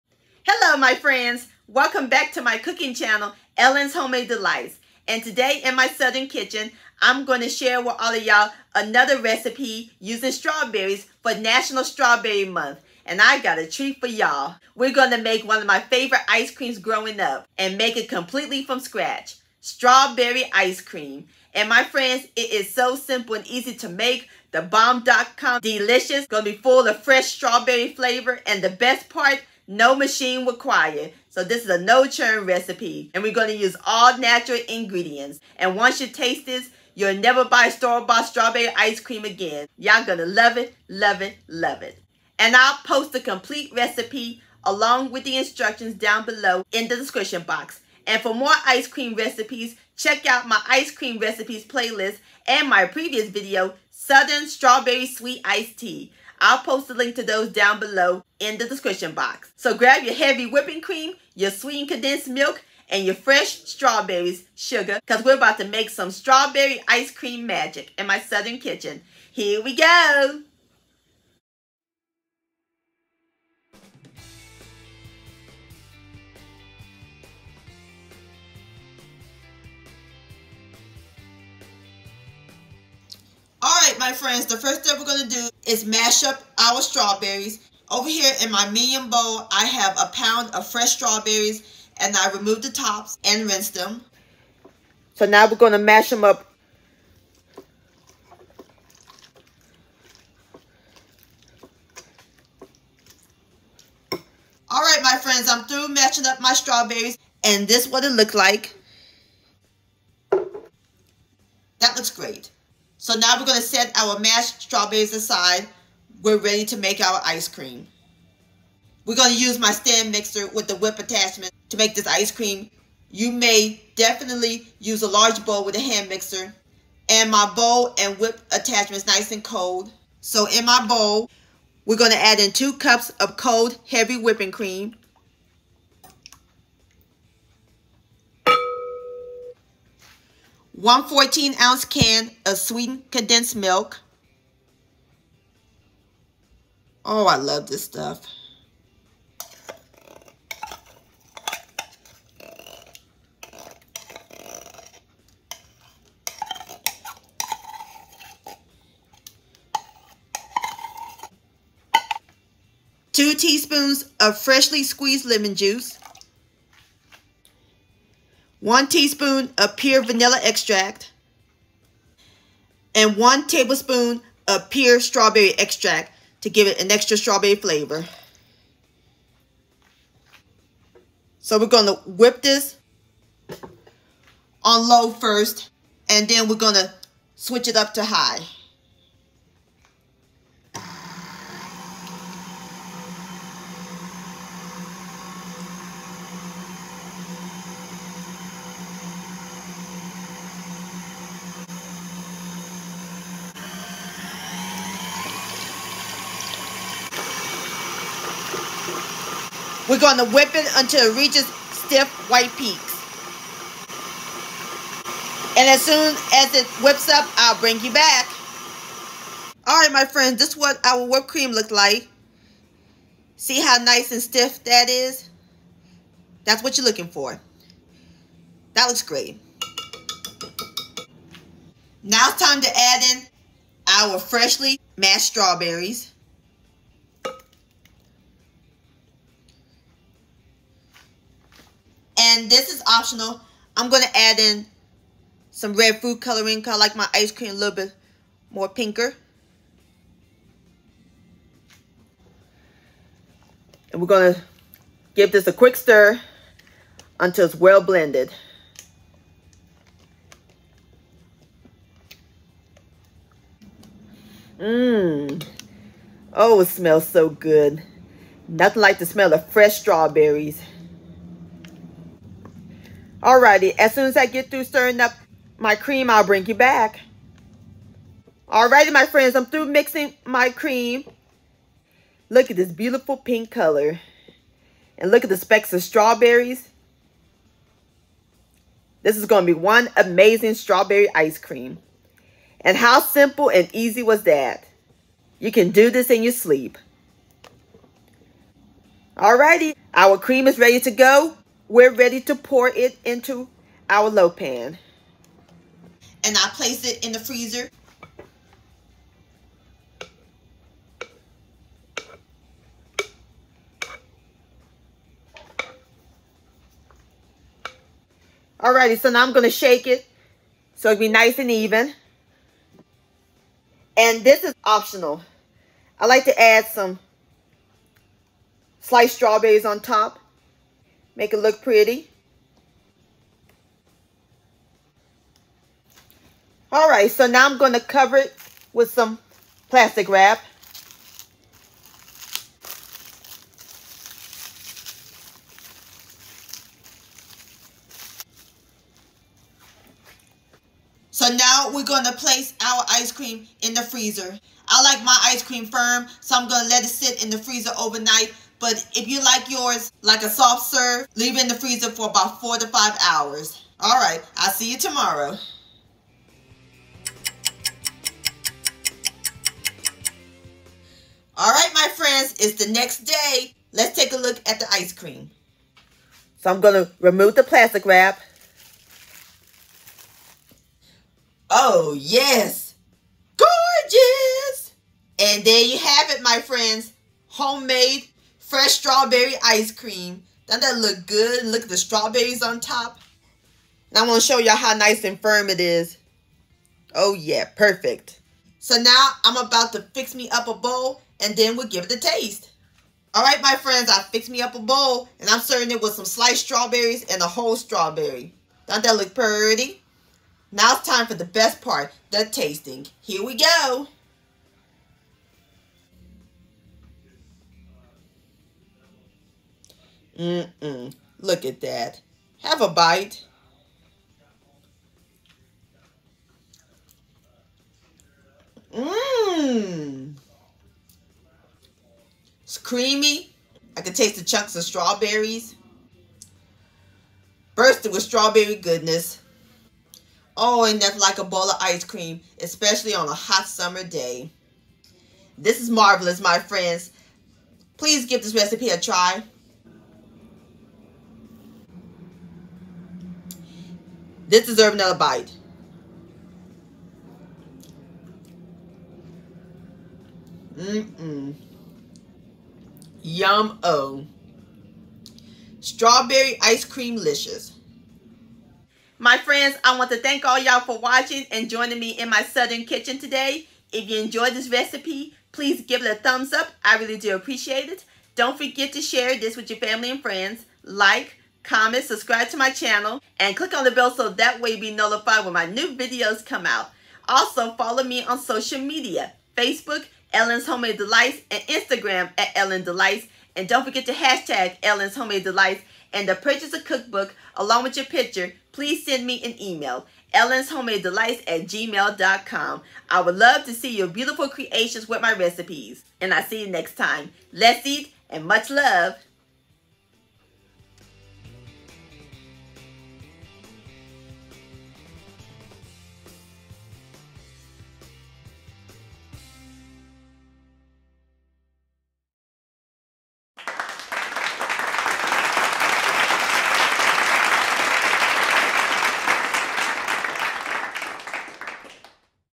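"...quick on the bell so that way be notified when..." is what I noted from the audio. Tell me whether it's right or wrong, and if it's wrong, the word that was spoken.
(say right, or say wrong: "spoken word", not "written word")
wrong: "click", not "quick".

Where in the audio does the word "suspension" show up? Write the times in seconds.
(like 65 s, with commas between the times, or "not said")
not said.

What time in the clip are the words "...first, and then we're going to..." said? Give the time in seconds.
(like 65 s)
185 s.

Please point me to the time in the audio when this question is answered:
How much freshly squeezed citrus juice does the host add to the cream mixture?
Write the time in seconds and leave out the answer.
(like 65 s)
163 s.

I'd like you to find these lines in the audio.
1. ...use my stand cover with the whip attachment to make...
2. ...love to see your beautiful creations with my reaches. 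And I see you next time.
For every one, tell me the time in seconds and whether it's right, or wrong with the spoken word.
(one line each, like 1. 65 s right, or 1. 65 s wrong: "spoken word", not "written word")
1. 119 s wrong: "mixer", not "cover"
2. 503 s wrong: "recipes", not "reaches".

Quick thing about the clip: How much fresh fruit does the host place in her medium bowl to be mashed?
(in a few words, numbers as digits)
1 pound.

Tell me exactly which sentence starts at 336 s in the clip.
All right, so now I'm going to cover it with some plastic wrap.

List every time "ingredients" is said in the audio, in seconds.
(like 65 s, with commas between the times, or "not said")
34 s.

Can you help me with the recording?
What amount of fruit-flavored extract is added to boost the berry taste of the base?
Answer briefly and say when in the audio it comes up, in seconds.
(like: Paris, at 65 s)
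1 tablespoon, at 173 s.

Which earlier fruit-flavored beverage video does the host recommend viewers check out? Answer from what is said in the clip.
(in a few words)
Southern Strawberry Sweet Iced Tea.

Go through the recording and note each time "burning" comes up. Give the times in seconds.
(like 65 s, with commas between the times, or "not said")
not said.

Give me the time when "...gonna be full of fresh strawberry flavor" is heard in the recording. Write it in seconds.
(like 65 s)
26 s.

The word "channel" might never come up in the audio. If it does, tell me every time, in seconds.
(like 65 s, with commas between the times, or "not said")
2 s, 482 s.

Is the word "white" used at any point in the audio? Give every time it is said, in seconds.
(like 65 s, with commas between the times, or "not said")
212 s.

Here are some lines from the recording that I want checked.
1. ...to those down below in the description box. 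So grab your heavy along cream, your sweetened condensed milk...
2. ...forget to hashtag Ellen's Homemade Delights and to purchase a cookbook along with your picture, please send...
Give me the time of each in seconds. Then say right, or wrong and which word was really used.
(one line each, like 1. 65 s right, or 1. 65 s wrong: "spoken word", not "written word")
1. 57 s wrong: "whipping", not "along"
2. 493 s right.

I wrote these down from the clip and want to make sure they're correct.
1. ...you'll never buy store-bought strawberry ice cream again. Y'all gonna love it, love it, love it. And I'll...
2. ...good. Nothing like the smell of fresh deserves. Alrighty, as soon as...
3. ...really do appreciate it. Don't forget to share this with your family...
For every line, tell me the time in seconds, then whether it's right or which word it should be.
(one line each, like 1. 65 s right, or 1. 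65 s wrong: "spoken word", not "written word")
1. 36 s right
2. 267 s wrong: "strawberries", not "deserves"
3. 476 s right.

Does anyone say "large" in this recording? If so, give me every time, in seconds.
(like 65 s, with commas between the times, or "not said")
125 s.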